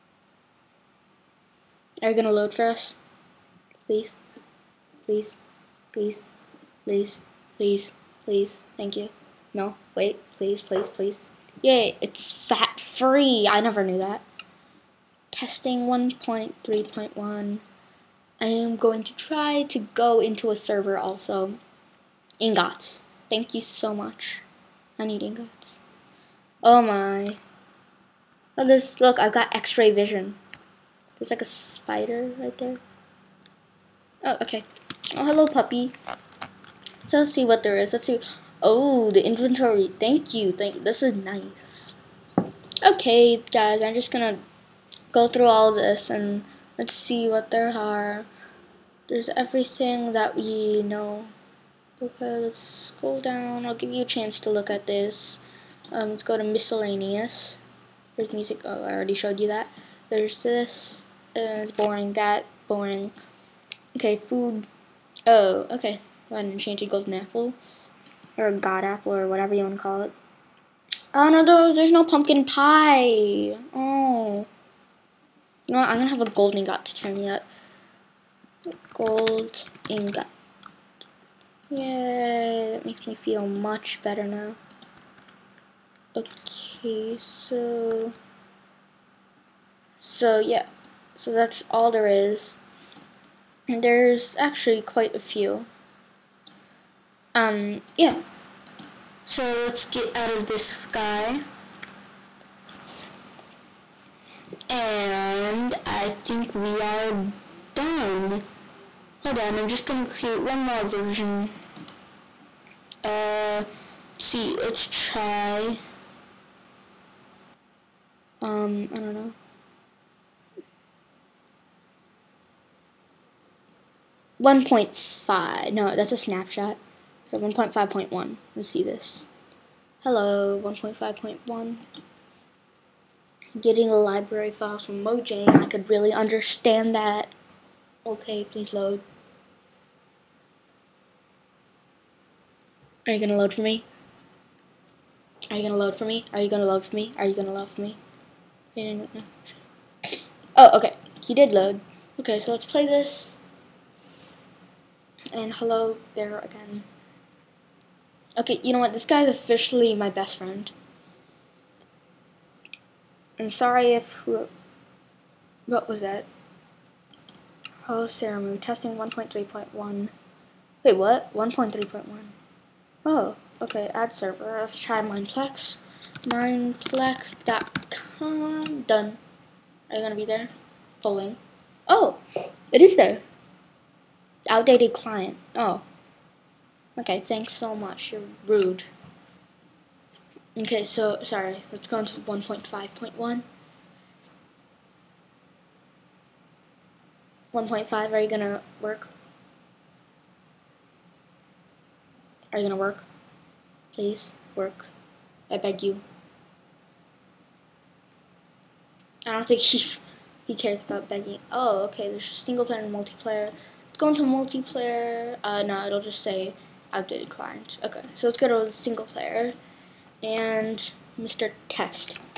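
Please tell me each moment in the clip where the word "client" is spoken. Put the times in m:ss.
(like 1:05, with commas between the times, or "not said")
3:04, 3:37.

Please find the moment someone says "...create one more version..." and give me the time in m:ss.
1:50.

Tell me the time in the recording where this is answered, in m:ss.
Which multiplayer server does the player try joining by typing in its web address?
2:56.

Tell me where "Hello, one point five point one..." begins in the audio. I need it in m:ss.
2:10.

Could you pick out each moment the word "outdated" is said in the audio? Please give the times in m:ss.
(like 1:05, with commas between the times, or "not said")
3:04, 3:36.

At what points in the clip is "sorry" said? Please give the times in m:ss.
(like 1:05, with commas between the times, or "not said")
2:43, 3:11.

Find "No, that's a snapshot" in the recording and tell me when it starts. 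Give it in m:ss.
2:05.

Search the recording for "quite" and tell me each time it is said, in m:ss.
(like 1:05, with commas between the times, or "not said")
1:34.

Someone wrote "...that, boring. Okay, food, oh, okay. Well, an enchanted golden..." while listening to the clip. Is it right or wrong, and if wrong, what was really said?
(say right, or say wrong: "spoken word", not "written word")
right.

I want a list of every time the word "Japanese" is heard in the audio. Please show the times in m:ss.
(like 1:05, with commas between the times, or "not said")
not said.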